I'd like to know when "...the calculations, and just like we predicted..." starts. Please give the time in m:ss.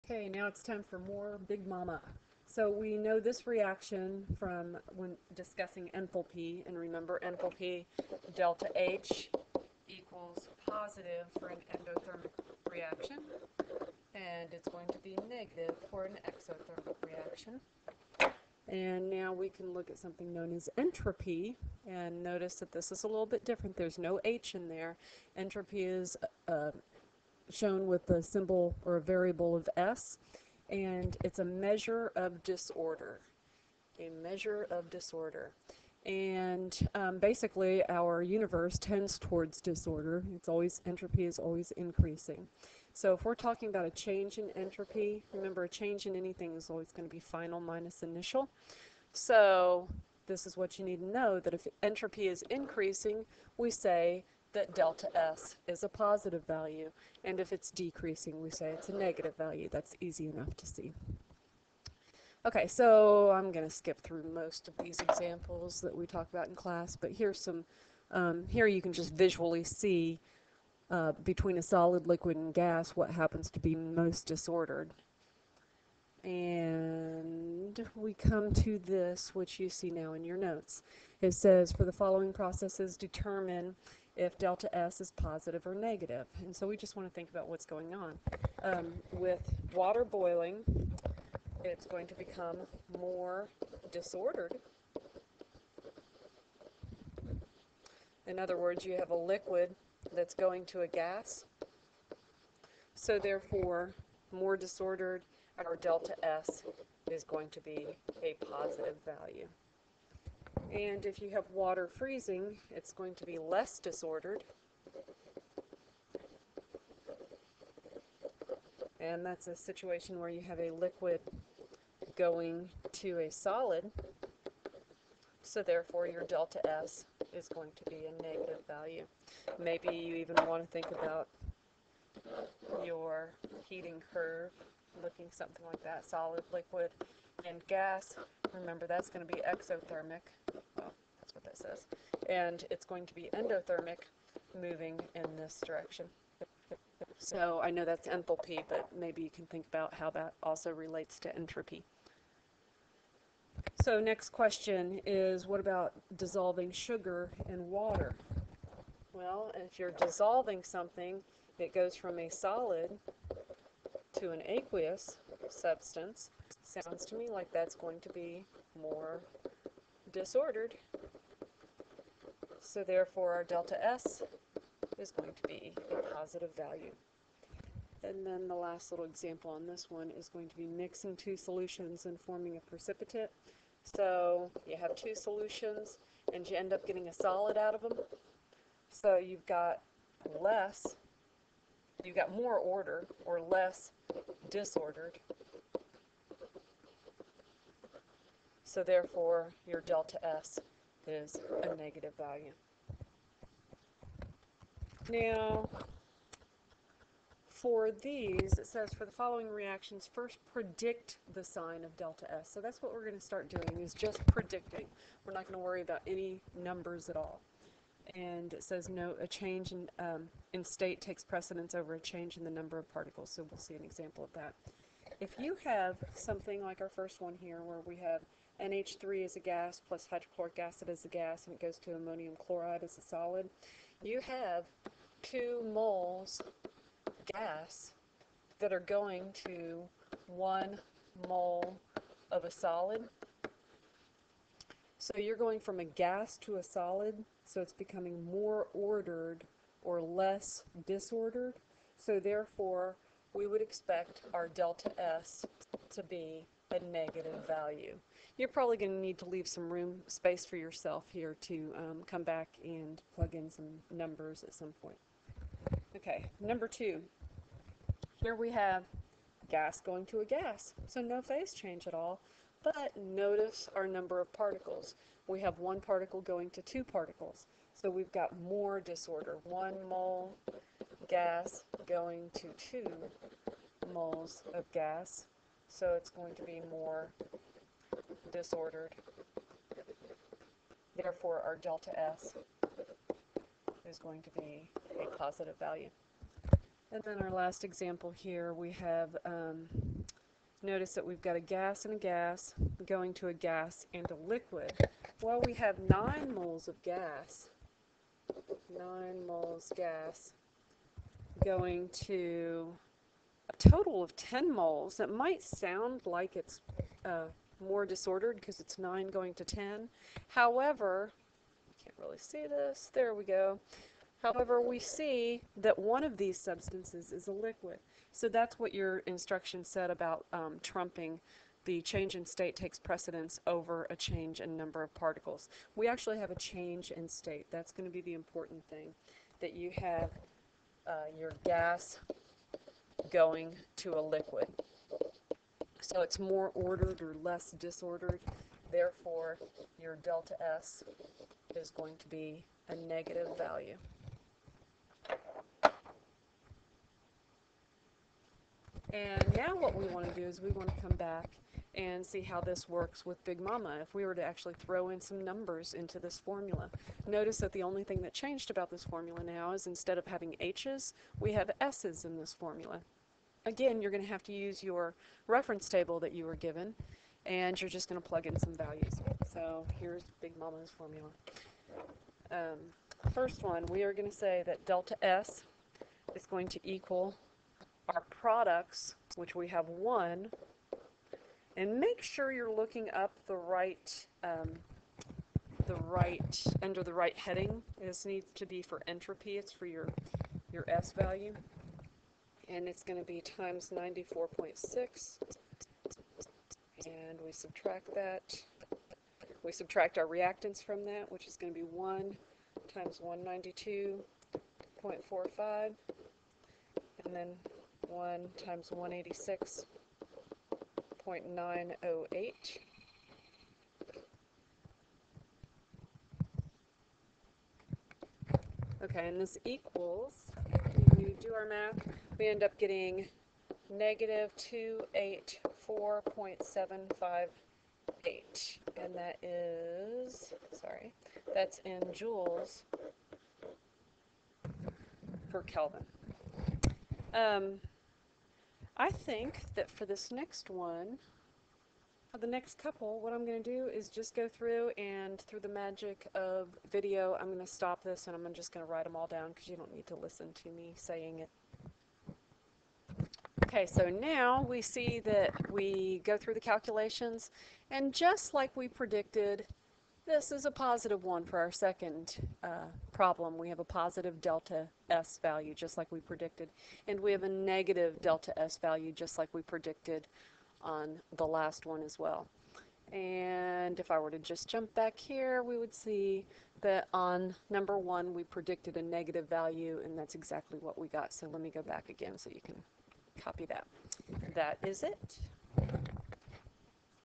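7:46.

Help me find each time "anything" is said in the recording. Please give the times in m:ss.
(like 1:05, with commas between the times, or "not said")
0:46.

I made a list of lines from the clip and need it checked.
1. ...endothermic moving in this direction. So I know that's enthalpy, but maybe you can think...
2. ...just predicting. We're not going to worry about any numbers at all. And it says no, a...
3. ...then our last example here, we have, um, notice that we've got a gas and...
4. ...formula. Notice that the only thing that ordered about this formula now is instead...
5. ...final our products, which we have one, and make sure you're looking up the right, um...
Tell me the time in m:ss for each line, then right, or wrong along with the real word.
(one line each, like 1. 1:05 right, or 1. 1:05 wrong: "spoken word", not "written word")
1. 2:23 right
2. 3:33 right
3. 4:57 right
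4. 6:06 wrong: "changed", not "ordered"
5. 6:26 wrong: "equal", not "final".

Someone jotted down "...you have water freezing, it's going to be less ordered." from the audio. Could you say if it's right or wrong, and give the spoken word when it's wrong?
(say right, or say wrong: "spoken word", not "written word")
wrong: "disordered", not "ordered".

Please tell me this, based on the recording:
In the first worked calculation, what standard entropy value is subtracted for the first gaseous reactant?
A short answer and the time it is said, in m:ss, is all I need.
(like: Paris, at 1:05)
192.45, at 6:53.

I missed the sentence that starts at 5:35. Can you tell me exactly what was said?
We actually have a change in state.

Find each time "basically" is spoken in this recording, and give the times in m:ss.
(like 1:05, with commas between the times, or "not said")
0:37.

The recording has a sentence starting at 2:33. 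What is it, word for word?
So next question is what about dissolving sugar in water?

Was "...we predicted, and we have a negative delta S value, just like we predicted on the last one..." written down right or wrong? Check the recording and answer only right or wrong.
right.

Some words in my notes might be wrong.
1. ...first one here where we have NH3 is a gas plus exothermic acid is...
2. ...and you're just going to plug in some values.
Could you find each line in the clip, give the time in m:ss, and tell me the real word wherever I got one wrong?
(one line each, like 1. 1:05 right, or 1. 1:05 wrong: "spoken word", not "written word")
1. 3:46 wrong: "hydrochloric", not "exothermic"
2. 6:17 right.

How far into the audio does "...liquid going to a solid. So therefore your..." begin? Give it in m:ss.
2:00.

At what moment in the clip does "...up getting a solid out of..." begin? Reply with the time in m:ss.
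3:06.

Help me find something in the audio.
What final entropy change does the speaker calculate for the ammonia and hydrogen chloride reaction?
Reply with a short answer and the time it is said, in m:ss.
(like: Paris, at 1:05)
-284.758, at 7:13.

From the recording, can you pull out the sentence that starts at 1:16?
And we come to this, which you see now in your notes.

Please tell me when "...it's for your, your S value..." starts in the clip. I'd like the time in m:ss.
6:39.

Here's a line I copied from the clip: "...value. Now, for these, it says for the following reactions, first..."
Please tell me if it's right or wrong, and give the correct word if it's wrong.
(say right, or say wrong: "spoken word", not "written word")
right.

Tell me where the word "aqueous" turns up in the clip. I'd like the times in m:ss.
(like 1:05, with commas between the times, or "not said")
2:44.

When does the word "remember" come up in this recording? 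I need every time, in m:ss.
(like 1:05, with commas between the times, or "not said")
0:06, 0:45, 2:18.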